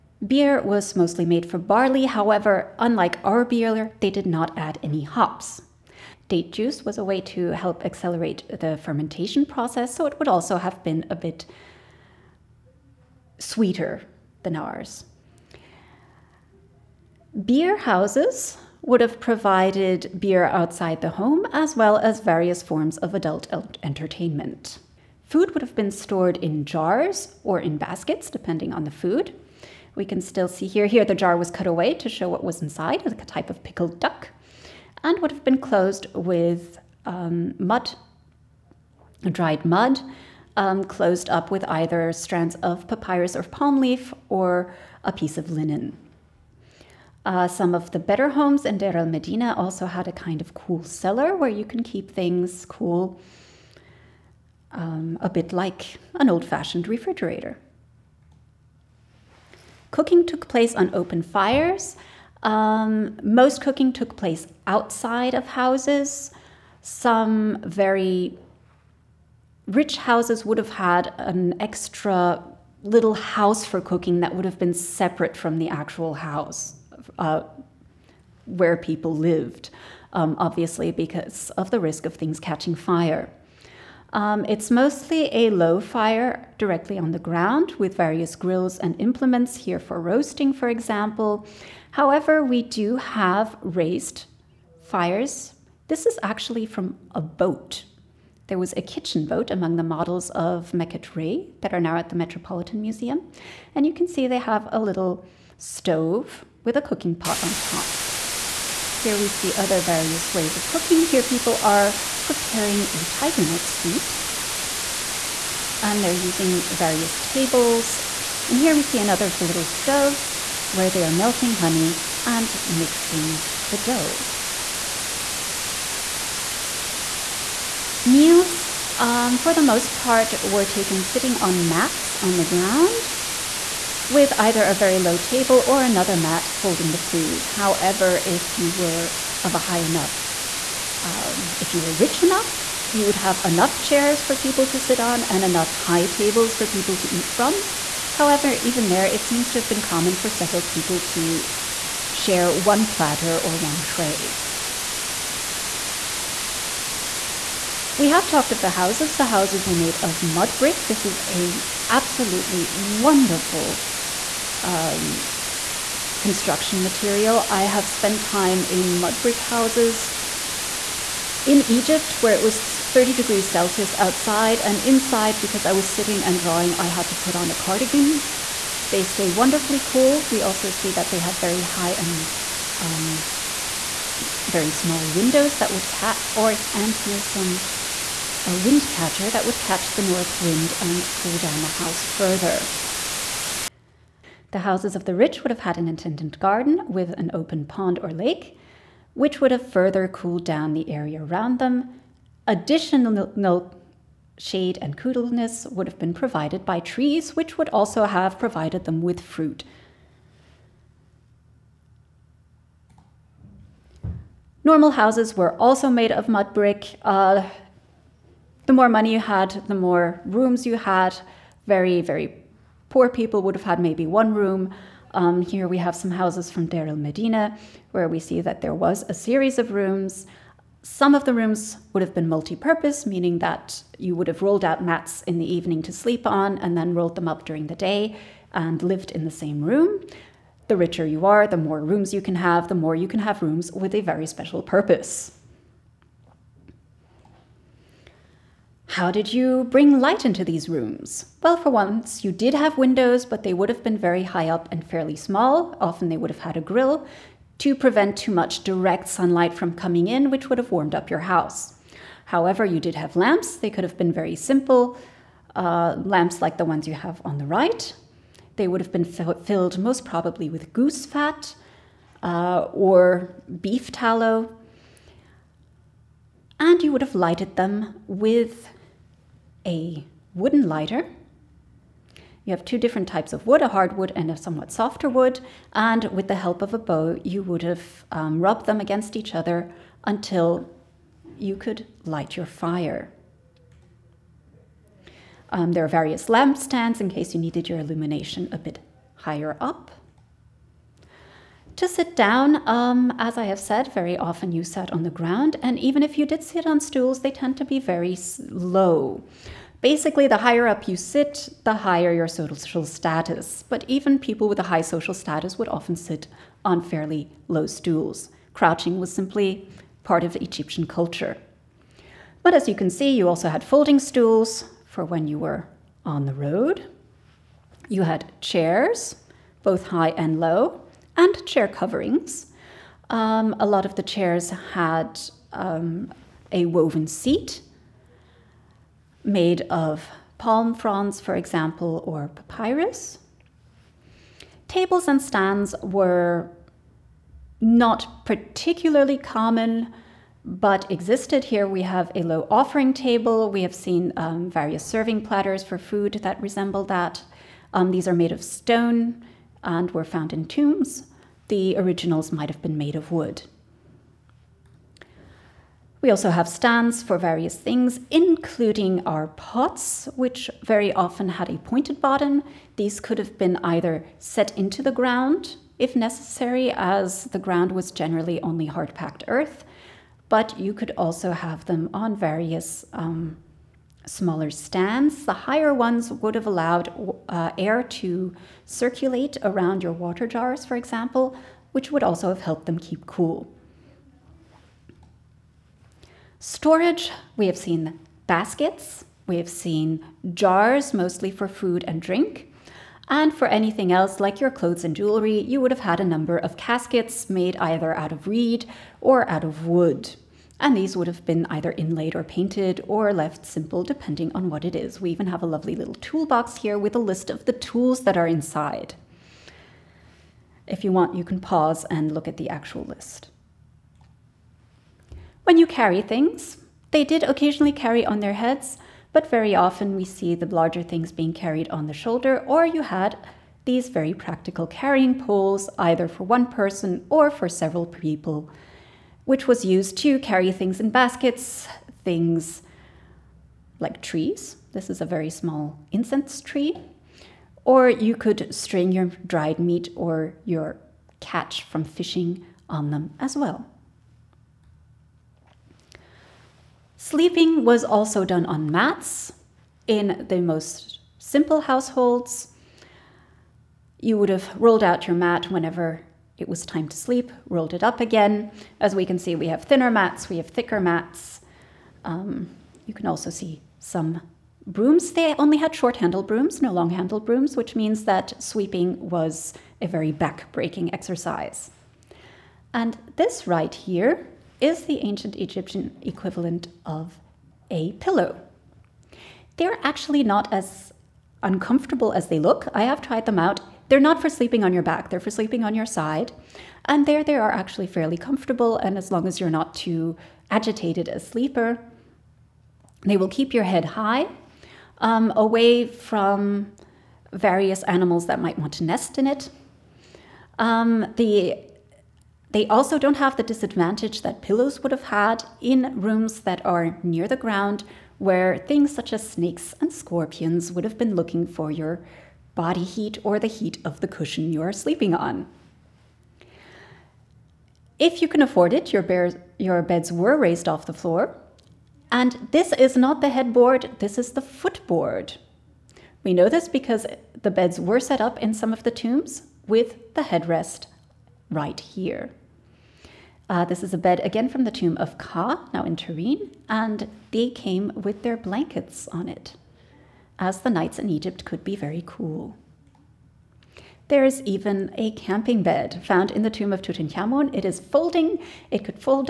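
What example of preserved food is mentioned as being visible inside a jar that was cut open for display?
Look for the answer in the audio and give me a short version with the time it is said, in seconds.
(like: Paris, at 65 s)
Pickled duck, at 33 s.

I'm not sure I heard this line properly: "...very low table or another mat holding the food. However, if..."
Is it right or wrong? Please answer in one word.
right.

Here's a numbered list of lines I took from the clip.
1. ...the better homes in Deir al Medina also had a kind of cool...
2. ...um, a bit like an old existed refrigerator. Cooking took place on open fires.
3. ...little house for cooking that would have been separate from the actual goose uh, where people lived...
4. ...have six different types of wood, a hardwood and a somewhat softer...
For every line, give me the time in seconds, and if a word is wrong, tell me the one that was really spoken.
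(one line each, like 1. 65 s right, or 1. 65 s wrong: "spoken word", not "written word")
1. 47 s right
2. 54 s wrong: "fashioned", not "existed"
3. 72 s wrong: "house", not "goose"
4. 282 s wrong: "two", not "six".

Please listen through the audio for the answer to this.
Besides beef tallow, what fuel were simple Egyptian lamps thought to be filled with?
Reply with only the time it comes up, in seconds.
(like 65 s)
270 s.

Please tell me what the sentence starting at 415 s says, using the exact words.
We even have a lovely little toolbox here with a list of the tools that are inside.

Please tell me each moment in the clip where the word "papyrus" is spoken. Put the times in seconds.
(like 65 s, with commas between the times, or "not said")
42 s, 342 s.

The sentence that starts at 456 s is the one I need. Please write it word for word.
Sleeping was also done on mats in the most simple households.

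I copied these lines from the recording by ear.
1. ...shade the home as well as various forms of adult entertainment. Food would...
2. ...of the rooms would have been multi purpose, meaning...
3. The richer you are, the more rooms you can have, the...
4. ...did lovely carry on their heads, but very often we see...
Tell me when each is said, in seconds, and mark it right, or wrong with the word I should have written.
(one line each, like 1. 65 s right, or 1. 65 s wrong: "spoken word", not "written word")
1. 20 s wrong: "outside", not "shade"
2. 231 s right
3. 240 s right
4. 427 s wrong: "occasionally", not "lovely".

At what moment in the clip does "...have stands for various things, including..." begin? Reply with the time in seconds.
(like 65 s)
366 s.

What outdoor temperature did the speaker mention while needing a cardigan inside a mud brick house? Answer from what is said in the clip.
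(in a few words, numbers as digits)
30 degrees Celsius.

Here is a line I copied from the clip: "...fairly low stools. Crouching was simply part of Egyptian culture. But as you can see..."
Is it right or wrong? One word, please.
right.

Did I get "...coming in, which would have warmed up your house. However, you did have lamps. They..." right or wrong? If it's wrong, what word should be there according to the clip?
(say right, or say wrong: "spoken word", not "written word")
right.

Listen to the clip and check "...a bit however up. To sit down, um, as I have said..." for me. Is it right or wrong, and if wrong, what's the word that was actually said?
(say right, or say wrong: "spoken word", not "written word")
wrong: "higher", not "however".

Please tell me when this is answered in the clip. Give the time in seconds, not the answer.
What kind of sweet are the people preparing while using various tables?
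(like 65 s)
113 s.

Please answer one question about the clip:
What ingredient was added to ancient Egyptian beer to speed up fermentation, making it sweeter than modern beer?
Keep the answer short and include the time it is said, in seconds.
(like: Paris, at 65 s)
Date juice, at 6 s.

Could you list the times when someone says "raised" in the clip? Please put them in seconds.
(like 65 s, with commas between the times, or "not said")
93 s, 530 s.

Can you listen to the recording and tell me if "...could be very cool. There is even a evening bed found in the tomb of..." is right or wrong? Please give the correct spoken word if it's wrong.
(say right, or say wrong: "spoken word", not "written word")
wrong: "camping", not "evening".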